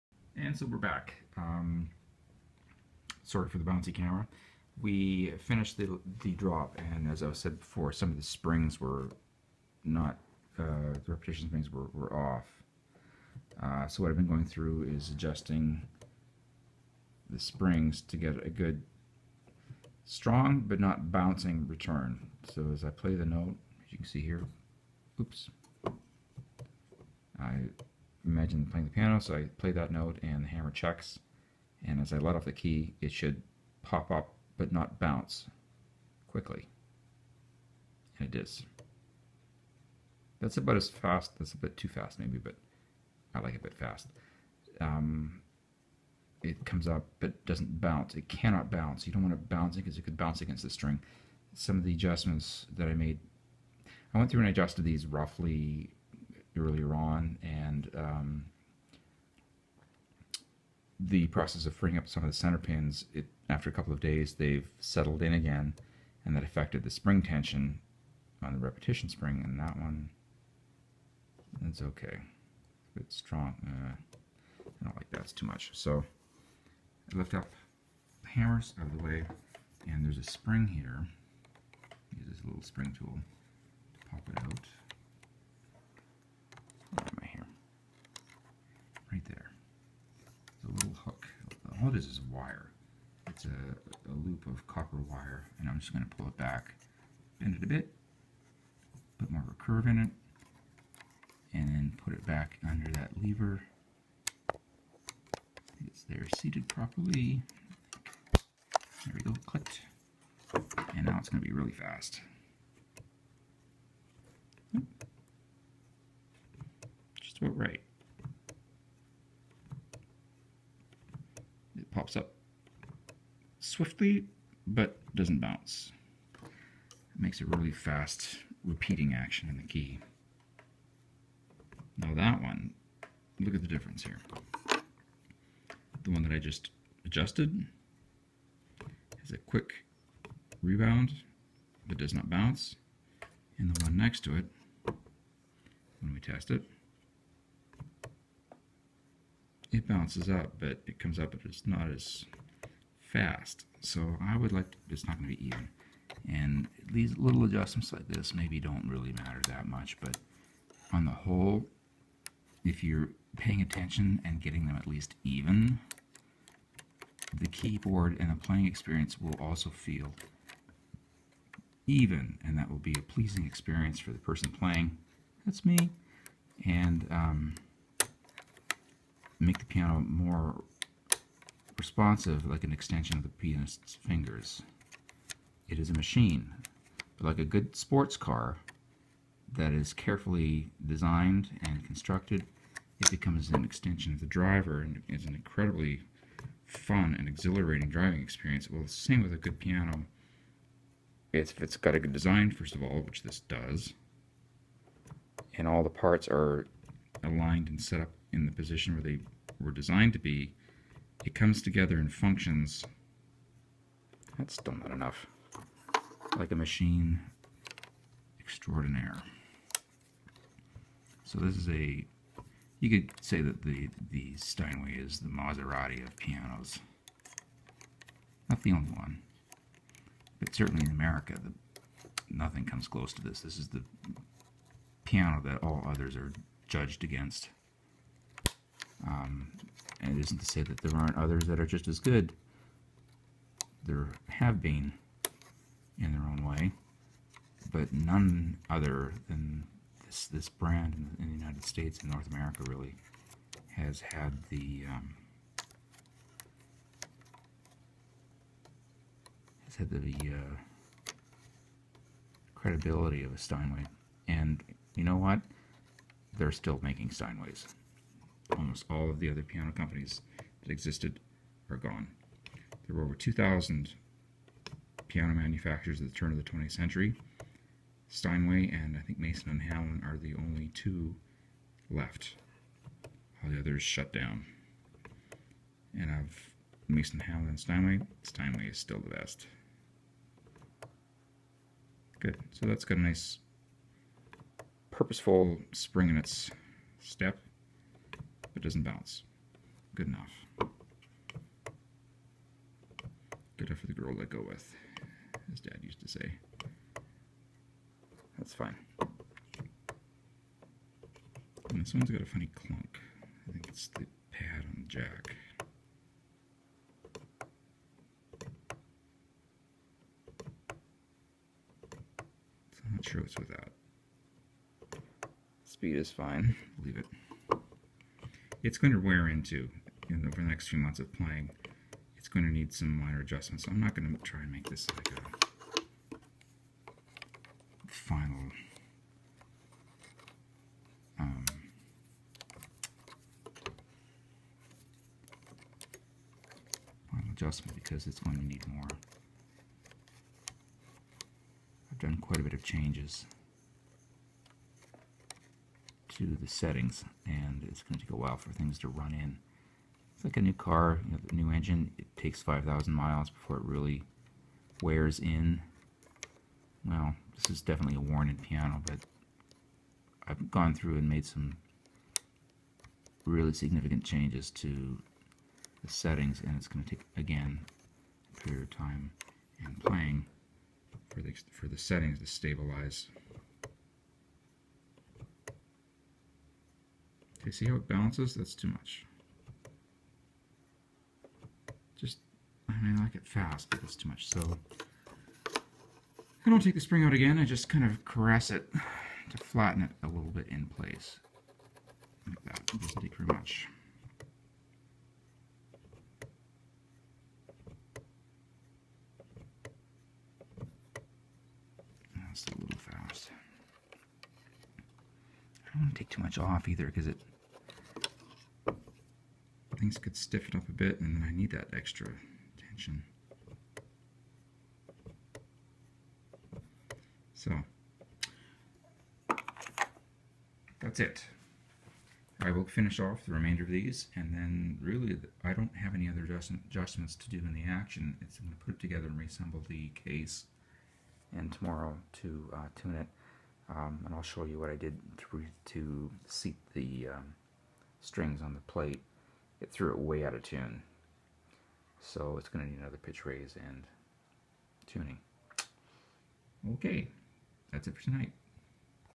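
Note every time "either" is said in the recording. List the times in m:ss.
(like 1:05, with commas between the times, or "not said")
6:56.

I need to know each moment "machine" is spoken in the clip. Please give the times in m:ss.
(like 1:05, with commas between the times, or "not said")
3:05, 3:36.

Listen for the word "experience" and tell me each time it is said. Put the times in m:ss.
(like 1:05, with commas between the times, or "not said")
2:48, 2:53, 3:18.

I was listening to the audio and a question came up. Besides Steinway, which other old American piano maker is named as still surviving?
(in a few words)
Mason and Hamlin.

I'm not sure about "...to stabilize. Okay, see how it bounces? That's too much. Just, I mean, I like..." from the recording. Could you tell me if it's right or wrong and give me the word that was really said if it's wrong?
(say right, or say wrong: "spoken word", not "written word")
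right.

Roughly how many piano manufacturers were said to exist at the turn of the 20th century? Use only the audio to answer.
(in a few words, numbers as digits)
Over 2,000.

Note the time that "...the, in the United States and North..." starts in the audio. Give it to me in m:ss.
4:11.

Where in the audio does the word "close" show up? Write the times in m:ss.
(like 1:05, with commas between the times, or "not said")
3:52.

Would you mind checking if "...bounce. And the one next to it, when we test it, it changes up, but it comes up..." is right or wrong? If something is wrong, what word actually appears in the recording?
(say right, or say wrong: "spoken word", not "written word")
wrong: "bounces", not "changes".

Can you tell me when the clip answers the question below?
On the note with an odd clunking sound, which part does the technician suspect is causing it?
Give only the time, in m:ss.
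5:13.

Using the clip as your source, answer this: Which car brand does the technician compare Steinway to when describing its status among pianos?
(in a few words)
Maserati.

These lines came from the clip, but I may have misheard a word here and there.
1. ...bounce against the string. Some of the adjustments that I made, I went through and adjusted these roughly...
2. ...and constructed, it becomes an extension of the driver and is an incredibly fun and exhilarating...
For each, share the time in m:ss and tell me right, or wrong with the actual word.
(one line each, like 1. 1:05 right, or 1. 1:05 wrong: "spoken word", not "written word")
1. 0:50 right
2. 3:11 right.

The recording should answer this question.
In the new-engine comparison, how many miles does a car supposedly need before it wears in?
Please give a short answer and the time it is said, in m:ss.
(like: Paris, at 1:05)
5,000 miles, at 6:02.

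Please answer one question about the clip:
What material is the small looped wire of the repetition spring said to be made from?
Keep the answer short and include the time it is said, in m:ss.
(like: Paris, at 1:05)
Copper, at 1:34.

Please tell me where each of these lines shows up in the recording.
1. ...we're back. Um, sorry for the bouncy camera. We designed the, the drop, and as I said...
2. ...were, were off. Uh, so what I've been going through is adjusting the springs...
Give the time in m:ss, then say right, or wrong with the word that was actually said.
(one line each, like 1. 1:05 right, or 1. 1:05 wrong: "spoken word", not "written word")
1. 0:00 wrong: "finished", not "designed"
2. 0:11 right.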